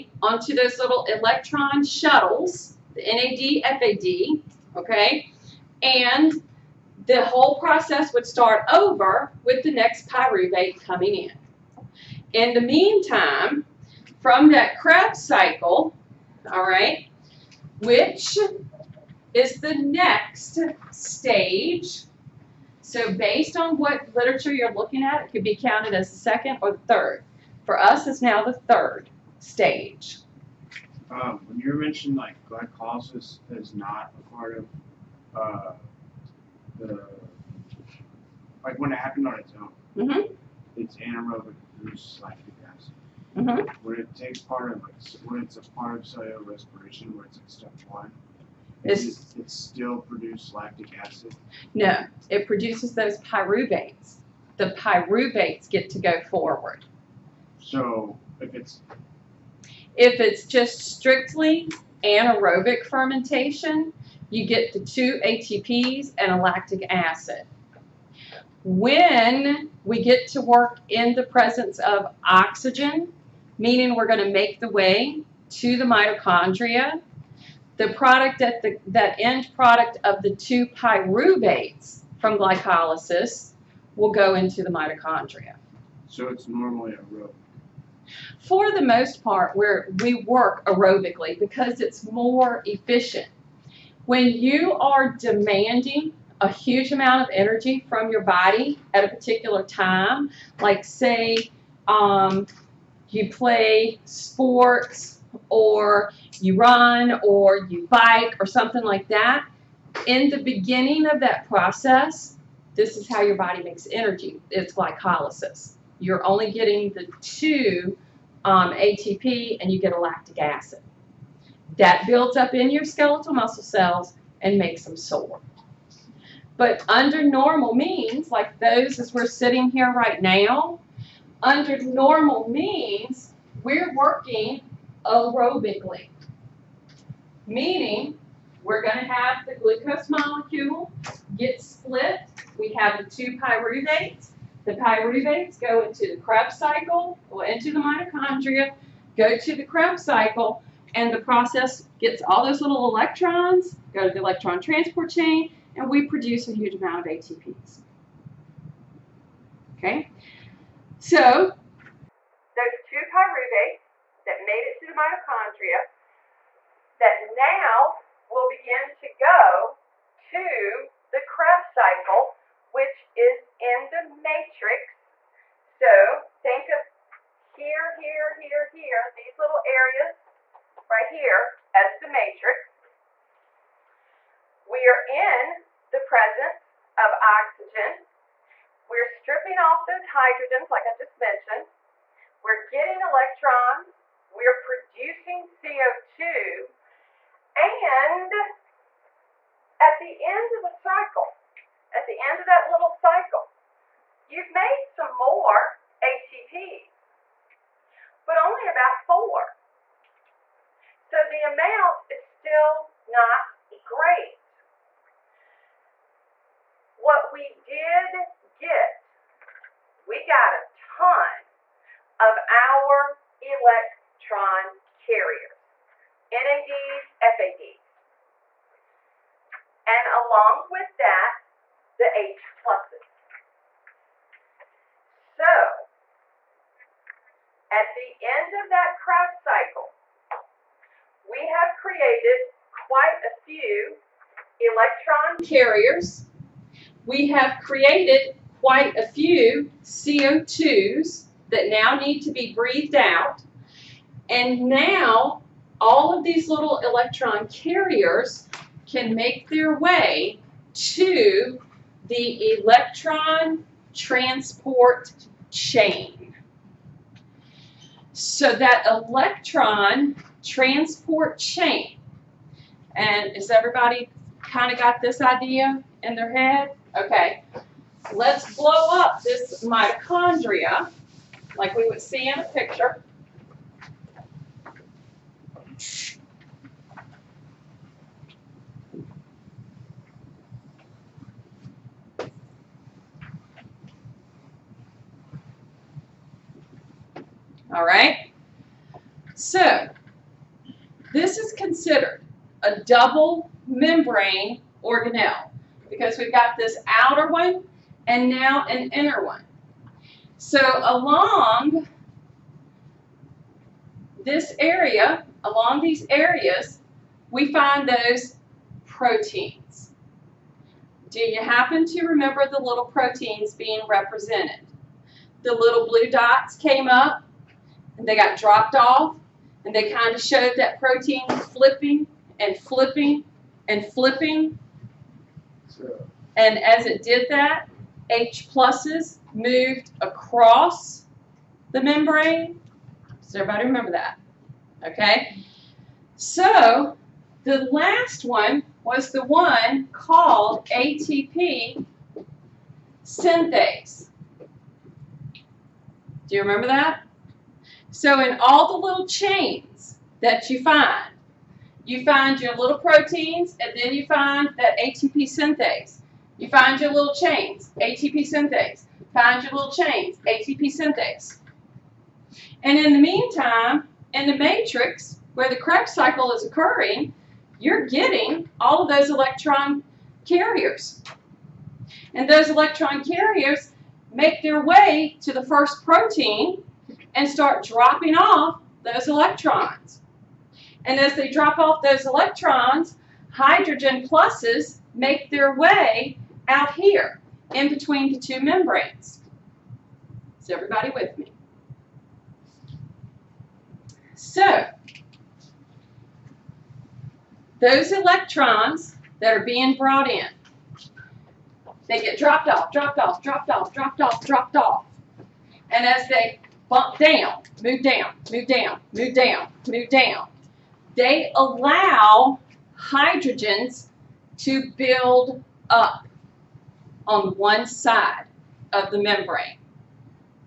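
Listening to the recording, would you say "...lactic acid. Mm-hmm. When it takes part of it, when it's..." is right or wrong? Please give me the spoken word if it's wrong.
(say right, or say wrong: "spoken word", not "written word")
right.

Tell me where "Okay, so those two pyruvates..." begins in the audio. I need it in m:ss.
2:39.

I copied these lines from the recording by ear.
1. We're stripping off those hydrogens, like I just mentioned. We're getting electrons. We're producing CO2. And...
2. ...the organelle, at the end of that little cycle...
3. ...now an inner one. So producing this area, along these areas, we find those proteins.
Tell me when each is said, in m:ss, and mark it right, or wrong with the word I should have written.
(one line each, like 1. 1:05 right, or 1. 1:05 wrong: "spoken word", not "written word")
1. 3:08 right
2. 3:20 wrong: "cycle", not "organelle"
3. 5:08 wrong: "along", not "producing".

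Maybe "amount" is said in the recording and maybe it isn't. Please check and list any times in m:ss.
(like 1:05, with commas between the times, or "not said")
1:36, 2:36, 3:31.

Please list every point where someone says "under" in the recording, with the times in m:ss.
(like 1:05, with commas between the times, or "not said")
2:06, 2:11.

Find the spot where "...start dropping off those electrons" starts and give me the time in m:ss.
6:27.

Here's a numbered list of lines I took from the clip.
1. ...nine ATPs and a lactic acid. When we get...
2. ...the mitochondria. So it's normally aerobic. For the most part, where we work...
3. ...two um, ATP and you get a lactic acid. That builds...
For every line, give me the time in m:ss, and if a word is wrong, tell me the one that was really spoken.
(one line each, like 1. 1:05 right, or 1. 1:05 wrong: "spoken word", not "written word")
1. 1:04 wrong: "two", not "nine"
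2. 1:24 right
3. 1:57 right.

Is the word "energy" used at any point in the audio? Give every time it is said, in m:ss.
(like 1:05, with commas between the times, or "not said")
1:37, 1:53.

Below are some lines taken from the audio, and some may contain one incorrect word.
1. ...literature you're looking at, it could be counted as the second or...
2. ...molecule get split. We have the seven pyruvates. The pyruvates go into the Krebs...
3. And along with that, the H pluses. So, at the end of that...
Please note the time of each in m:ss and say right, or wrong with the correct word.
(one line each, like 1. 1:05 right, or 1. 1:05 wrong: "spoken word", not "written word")
1. 0:24 right
2. 2:20 wrong: "two", not "seven"
3. 3:49 right.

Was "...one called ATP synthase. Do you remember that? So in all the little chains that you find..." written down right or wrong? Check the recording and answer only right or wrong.
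right.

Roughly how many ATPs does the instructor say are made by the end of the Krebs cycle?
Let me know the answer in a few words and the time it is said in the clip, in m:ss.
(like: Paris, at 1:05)
about 4, at 3:28.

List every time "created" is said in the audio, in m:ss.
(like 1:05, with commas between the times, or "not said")
4:01, 4:07.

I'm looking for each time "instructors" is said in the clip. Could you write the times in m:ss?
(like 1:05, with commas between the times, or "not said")
not said.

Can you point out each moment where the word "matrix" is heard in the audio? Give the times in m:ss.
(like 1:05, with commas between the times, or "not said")
2:54, 3:02, 6:14.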